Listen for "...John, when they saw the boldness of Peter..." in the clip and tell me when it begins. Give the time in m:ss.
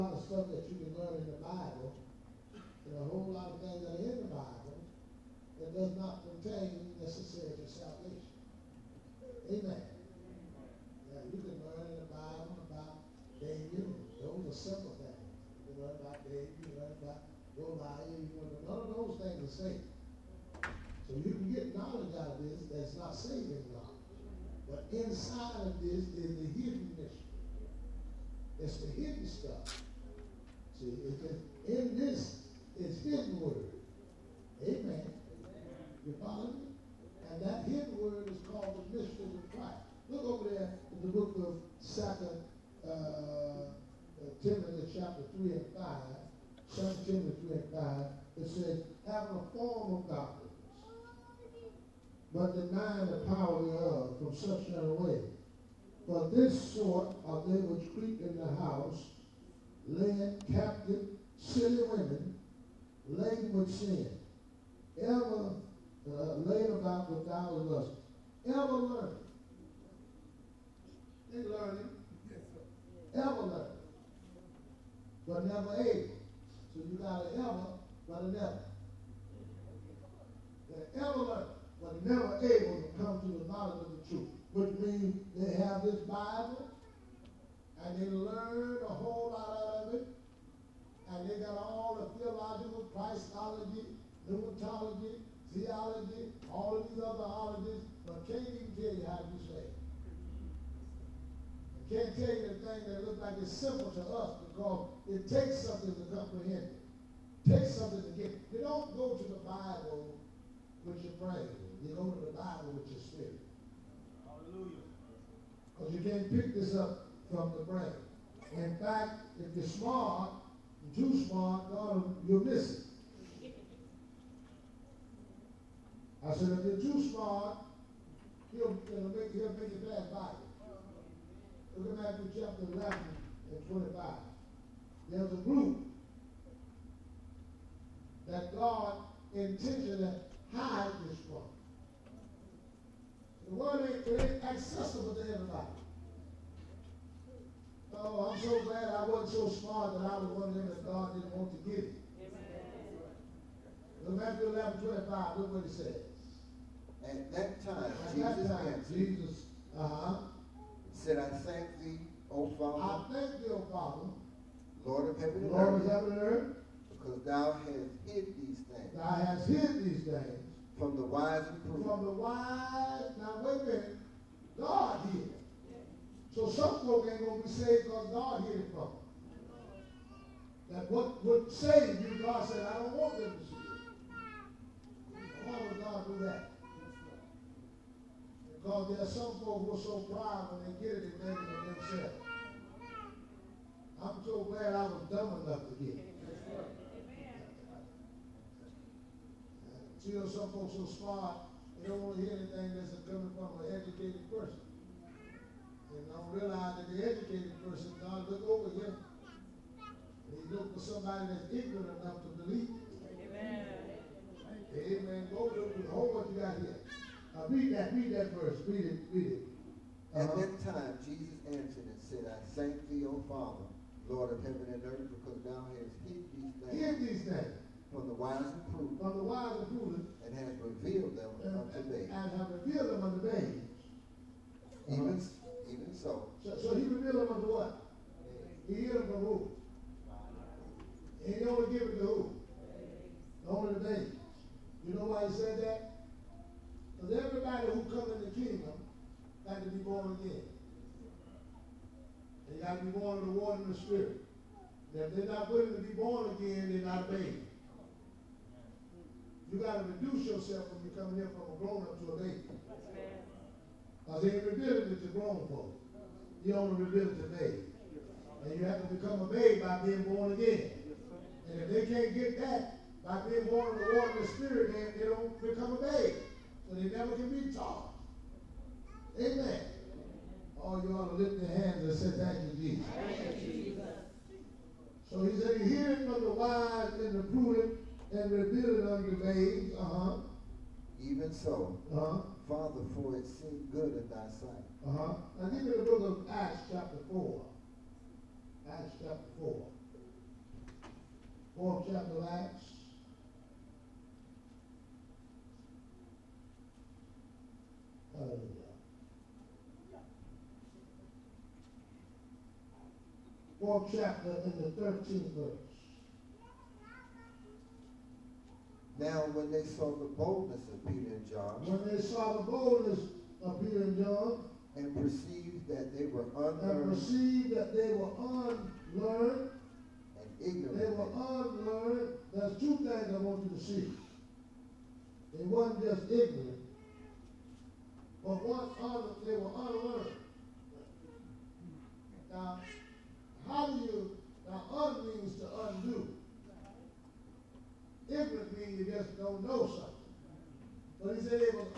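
5:21.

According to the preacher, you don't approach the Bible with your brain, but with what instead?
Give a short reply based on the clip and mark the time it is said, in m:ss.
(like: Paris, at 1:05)
your spirit, at 1:52.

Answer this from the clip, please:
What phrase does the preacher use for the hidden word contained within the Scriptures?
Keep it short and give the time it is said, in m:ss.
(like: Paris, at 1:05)
the mystery of Christ, at 0:38.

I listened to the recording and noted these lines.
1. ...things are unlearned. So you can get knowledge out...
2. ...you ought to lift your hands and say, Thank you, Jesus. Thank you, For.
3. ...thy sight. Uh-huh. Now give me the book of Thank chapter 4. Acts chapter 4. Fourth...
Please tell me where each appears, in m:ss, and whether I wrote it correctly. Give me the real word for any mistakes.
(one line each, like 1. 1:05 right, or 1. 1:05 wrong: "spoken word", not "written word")
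1. 0:19 wrong: "saved", not "unlearned"
2. 4:40 wrong: "Jesus", not "For"
3. 4:54 wrong: "Acts", not "Thank".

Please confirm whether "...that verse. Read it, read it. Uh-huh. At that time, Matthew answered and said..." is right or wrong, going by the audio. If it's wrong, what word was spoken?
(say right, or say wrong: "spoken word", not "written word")
wrong: "Jesus", not "Matthew".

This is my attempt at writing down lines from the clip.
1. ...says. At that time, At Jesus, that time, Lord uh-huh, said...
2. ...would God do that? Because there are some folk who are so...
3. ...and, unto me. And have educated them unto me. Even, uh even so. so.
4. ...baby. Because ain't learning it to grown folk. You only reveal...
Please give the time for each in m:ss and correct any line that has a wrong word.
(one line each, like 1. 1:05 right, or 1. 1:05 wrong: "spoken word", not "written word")
1. 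2:35 wrong: "Jesus", not "Lord"
2. 3:05 right
3. 3:51 wrong: "revealed", not "educated"
4. 4:22 wrong: "revealing", not "learning".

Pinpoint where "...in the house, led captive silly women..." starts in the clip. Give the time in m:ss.
0:58.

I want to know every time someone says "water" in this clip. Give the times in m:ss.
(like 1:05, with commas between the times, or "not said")
4:13, 4:33.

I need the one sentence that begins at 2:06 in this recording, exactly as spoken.
I said, if you're too smart, he'll, make, he'll make you bad Bible.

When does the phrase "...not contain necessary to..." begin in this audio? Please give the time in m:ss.
0:05.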